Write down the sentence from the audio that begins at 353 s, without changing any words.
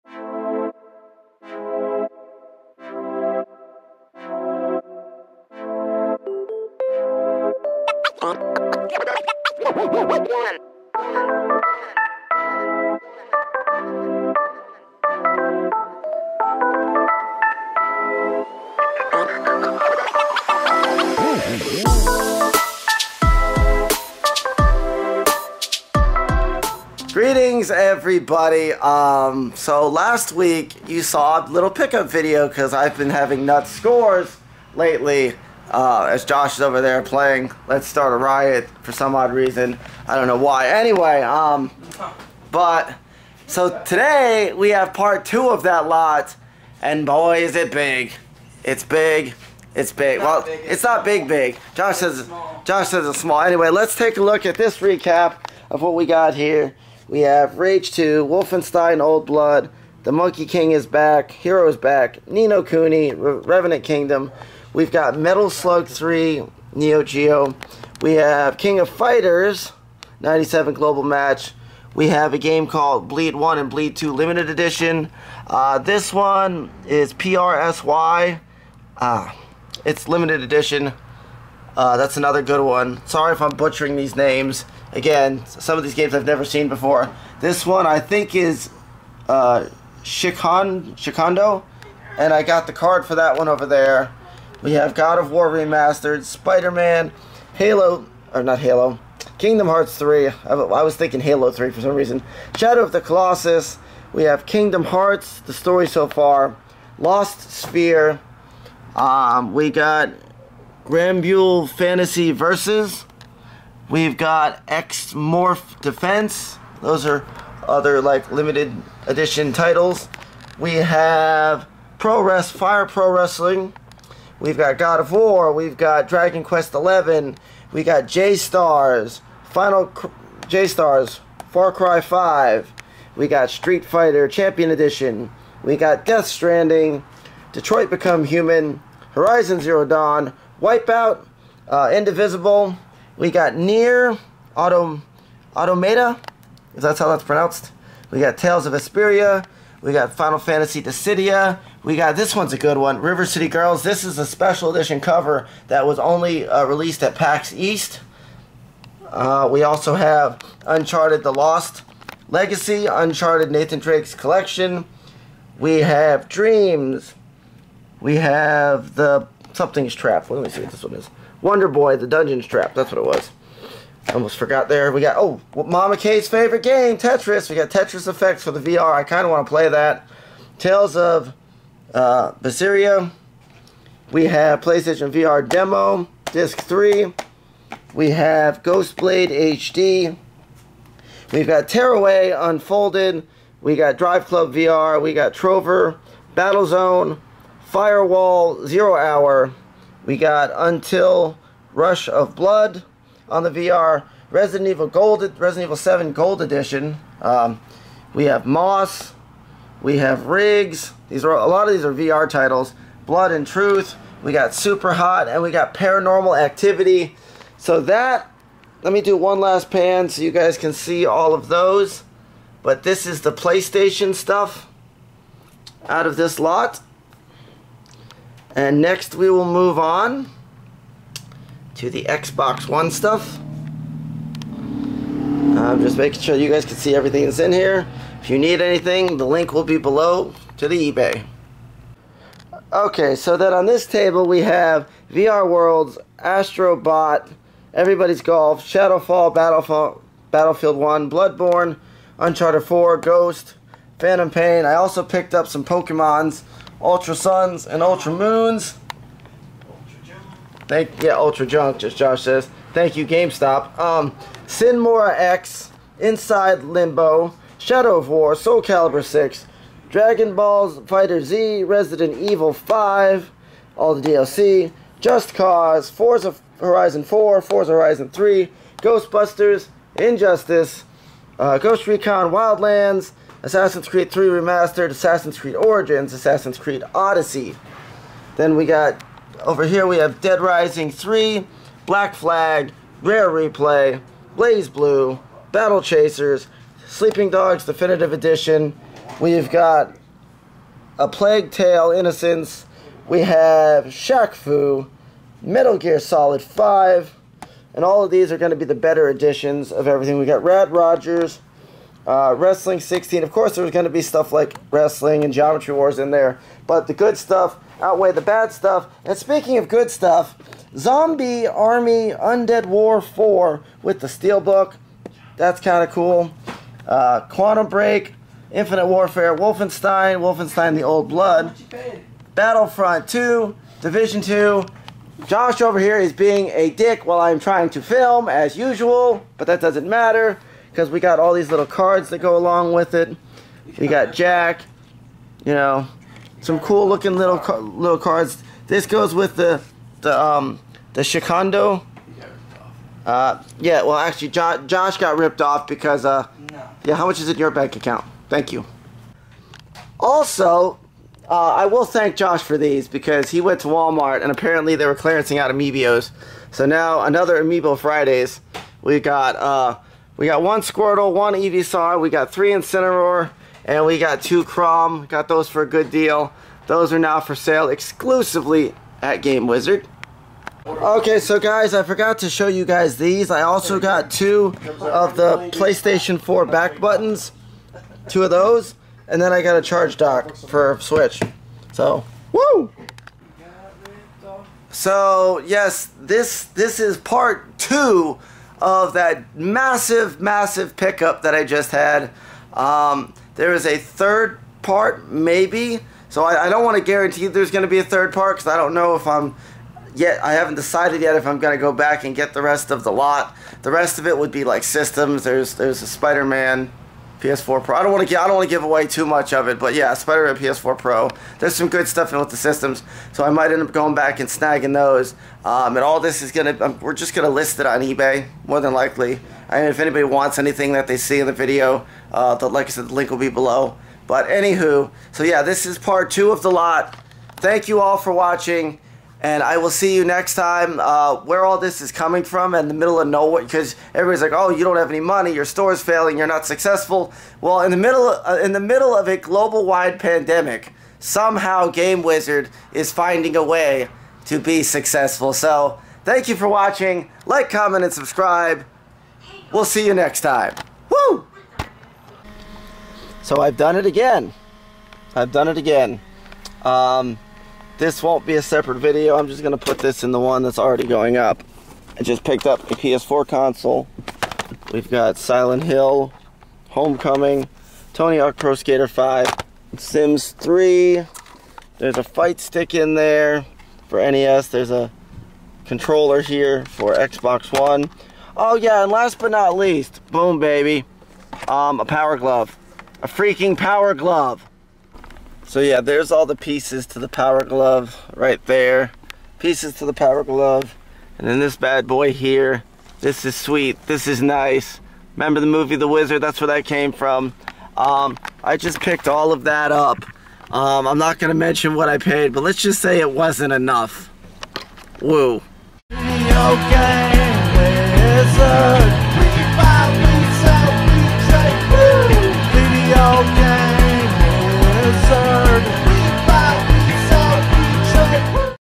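Uh, yeah, well, actually, jo Josh got ripped off because, uh, no.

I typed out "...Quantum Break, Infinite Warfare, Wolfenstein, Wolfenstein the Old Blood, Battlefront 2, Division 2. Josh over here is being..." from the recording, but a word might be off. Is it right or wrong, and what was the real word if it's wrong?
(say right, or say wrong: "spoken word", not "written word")
right.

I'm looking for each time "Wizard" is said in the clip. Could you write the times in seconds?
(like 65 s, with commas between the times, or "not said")
379 s, 452 s, 505 s.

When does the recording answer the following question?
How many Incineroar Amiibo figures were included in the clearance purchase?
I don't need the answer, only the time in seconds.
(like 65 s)
372 s.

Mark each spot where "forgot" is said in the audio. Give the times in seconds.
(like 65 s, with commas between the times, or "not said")
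174 s, 381 s.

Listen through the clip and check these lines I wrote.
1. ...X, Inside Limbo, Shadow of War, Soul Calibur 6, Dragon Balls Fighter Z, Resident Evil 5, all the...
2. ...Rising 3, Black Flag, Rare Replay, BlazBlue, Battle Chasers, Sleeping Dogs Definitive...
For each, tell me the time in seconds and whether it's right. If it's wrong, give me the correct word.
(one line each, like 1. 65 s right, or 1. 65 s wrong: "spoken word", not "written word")
1. 264 s right
2. 290 s right.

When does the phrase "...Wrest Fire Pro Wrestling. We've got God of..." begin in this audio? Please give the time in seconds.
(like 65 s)
122 s.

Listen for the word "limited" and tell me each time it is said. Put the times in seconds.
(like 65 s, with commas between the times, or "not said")
74 s, 80 s, 118 s.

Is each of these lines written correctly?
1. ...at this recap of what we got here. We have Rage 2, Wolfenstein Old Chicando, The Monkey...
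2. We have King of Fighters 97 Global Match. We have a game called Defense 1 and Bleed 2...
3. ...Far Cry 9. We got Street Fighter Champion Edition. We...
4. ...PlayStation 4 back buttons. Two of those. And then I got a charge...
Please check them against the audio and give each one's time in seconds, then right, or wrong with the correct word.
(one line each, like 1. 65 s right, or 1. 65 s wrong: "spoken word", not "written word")
1. 54 s wrong: "Blood", not "Chicando"
2. 68 s wrong: "Bleed", not "Defense"
3. 131 s wrong: "5", not "9"
4. 385 s right.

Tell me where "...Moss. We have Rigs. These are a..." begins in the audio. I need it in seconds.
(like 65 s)
208 s.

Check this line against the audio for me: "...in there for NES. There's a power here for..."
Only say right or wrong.
wrong.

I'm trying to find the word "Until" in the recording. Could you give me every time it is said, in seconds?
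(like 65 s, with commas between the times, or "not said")
200 s.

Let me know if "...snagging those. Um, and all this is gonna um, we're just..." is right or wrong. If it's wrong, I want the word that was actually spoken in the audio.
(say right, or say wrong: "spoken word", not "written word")
right.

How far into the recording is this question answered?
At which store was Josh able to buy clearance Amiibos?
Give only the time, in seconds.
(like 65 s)
363 s.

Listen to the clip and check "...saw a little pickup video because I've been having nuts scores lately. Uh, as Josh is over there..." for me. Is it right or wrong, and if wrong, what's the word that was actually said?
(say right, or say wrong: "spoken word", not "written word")
right.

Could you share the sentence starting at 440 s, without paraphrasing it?
Uh, where all this is coming from and the middle of nowhere, because everybody's like, "Oh, you don't have any money.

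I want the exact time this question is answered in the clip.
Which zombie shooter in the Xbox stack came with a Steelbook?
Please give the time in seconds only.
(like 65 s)
320 s.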